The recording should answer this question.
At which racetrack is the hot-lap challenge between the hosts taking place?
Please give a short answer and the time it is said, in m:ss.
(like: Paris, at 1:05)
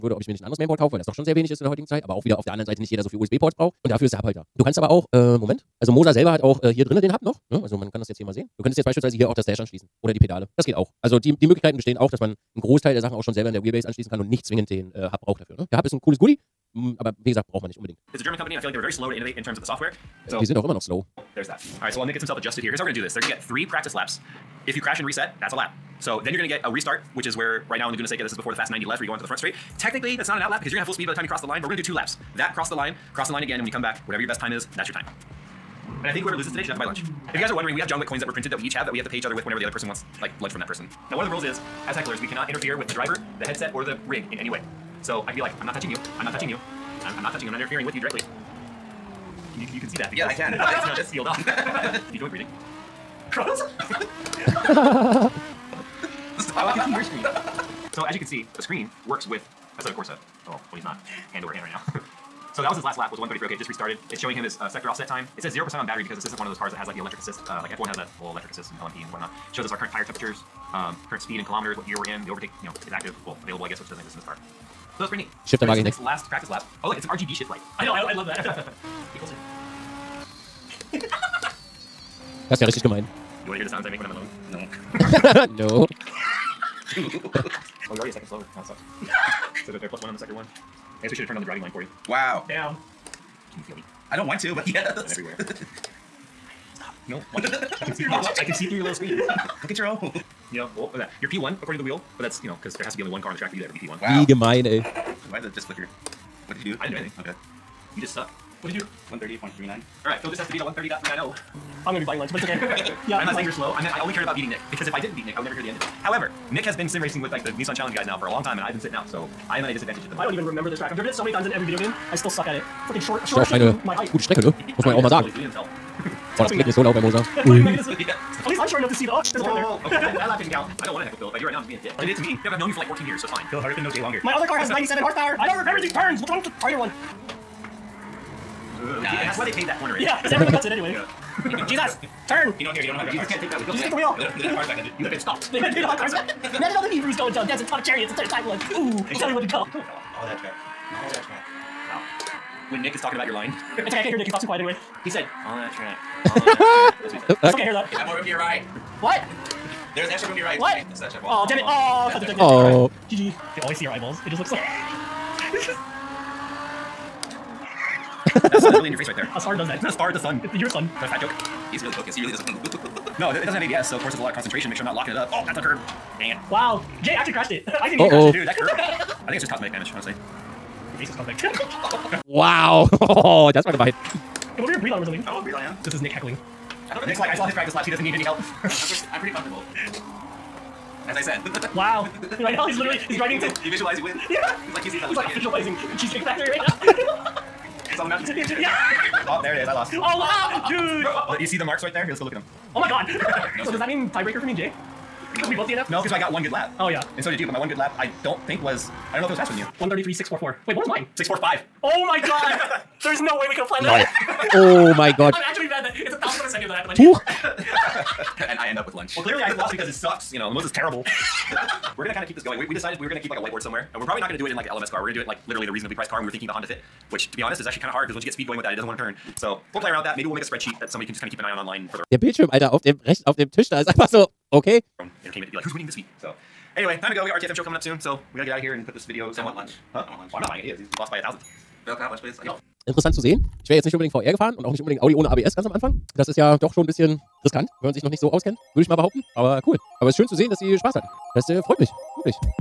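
Laguna Seca, at 0:27.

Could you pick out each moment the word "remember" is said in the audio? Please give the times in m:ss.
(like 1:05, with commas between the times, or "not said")
2:00, 2:15.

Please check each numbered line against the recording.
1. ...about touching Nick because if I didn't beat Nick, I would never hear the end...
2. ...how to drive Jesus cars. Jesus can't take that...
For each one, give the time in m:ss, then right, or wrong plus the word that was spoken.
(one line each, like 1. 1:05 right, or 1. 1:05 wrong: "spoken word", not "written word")
1. 1:54 wrong: "beating", not "touching"
2. 2:22 right.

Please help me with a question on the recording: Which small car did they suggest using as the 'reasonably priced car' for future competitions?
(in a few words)
Honda Fit.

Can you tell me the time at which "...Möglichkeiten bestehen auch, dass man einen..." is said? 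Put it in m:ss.
0:11.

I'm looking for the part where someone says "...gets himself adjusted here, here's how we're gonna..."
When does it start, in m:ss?
0:22.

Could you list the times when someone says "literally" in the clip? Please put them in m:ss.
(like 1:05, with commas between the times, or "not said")
3:12, 3:45.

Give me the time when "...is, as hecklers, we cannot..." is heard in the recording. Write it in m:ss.
0:41.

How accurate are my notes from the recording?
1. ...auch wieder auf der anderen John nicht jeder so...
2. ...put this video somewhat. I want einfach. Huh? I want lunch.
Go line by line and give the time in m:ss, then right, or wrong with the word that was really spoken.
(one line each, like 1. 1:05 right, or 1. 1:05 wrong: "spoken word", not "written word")
1. 0:02 wrong: "Seite", not "John"
2. 3:58 wrong: "lunch", not "einfach".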